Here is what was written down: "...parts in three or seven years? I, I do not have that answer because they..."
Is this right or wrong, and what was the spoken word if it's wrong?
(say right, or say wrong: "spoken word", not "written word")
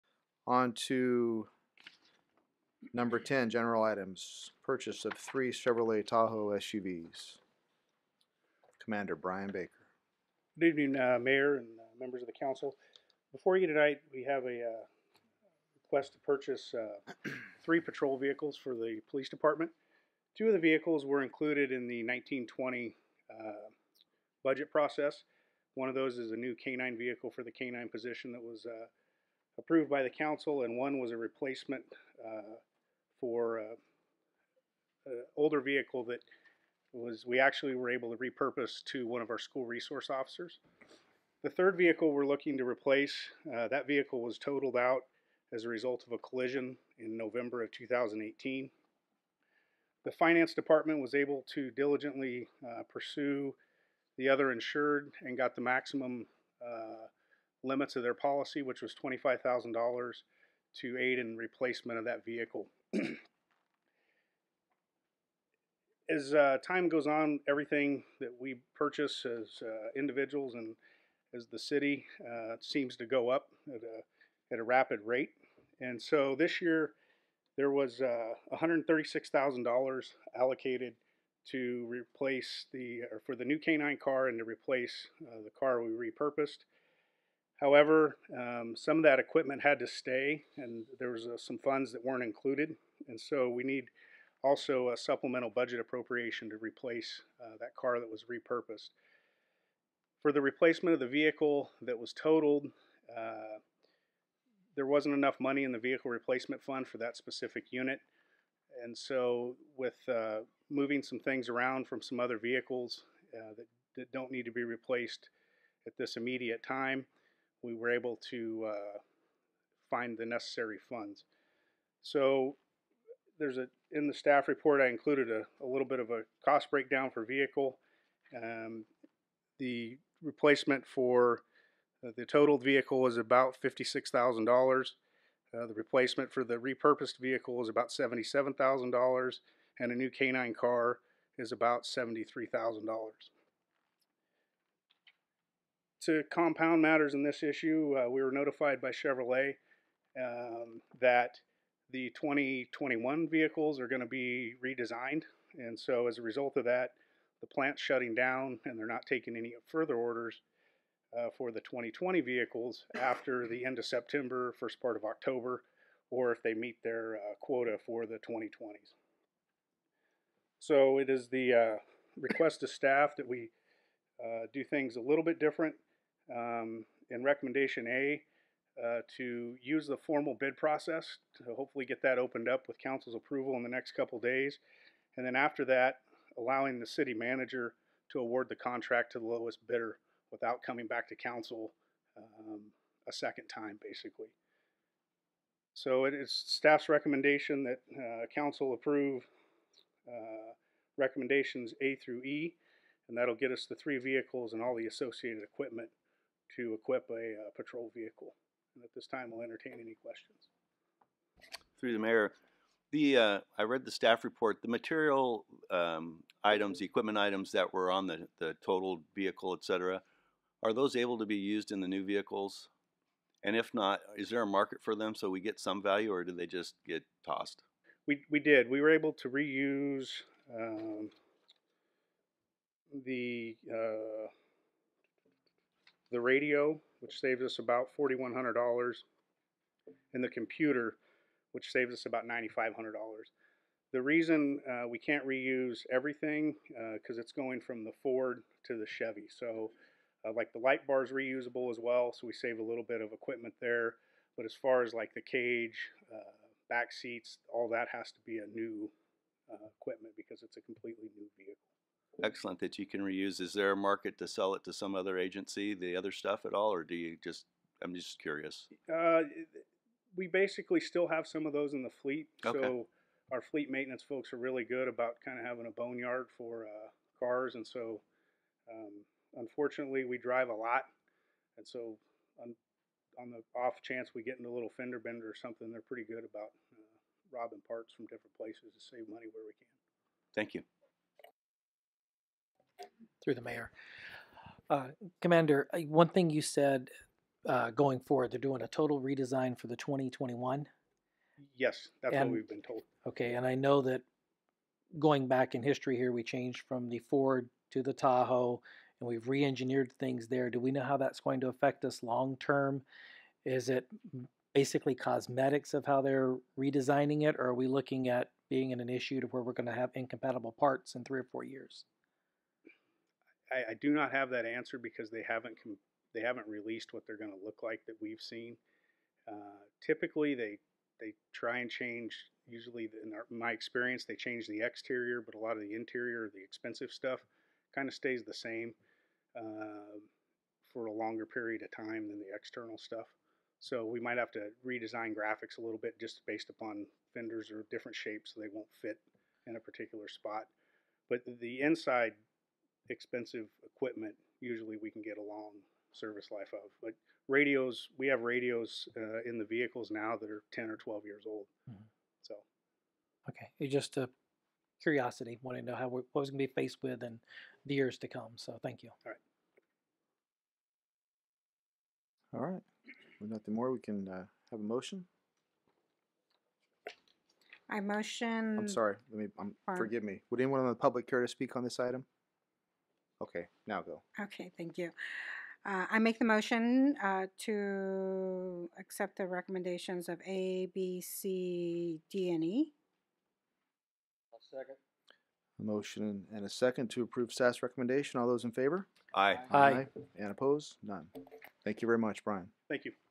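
wrong: "four", not "seven".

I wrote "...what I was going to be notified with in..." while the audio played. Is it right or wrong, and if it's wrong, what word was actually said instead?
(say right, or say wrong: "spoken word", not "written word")
wrong: "faced", not "notified".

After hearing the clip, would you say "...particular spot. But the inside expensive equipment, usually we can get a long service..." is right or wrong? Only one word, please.
right.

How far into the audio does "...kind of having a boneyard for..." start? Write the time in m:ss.
4:35.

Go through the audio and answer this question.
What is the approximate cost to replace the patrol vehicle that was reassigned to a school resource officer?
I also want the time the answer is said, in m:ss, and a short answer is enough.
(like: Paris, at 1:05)
$77,000, at 2:17.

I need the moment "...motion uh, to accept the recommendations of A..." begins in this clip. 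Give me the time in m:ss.
6:26.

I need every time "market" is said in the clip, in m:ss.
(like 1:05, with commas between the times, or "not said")
3:44, 4:23.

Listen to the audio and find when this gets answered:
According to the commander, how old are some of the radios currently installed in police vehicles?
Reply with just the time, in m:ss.
6:00.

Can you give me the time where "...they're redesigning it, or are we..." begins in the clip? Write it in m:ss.
5:16.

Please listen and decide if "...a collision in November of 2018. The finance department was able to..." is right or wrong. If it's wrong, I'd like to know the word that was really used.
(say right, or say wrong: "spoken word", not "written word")
right.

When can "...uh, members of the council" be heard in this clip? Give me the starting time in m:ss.
0:11.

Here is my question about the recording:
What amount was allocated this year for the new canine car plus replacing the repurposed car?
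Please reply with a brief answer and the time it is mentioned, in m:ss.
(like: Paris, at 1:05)
$136,000, at 1:18.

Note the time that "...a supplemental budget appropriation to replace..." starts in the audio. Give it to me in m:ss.
1:34.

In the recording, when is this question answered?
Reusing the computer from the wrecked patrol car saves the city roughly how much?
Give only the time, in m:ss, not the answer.
4:02.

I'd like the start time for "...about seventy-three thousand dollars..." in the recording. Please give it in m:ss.
2:21.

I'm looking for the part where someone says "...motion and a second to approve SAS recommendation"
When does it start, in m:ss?
6:35.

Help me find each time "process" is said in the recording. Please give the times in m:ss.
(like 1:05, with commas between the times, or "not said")
0:24, 3:00.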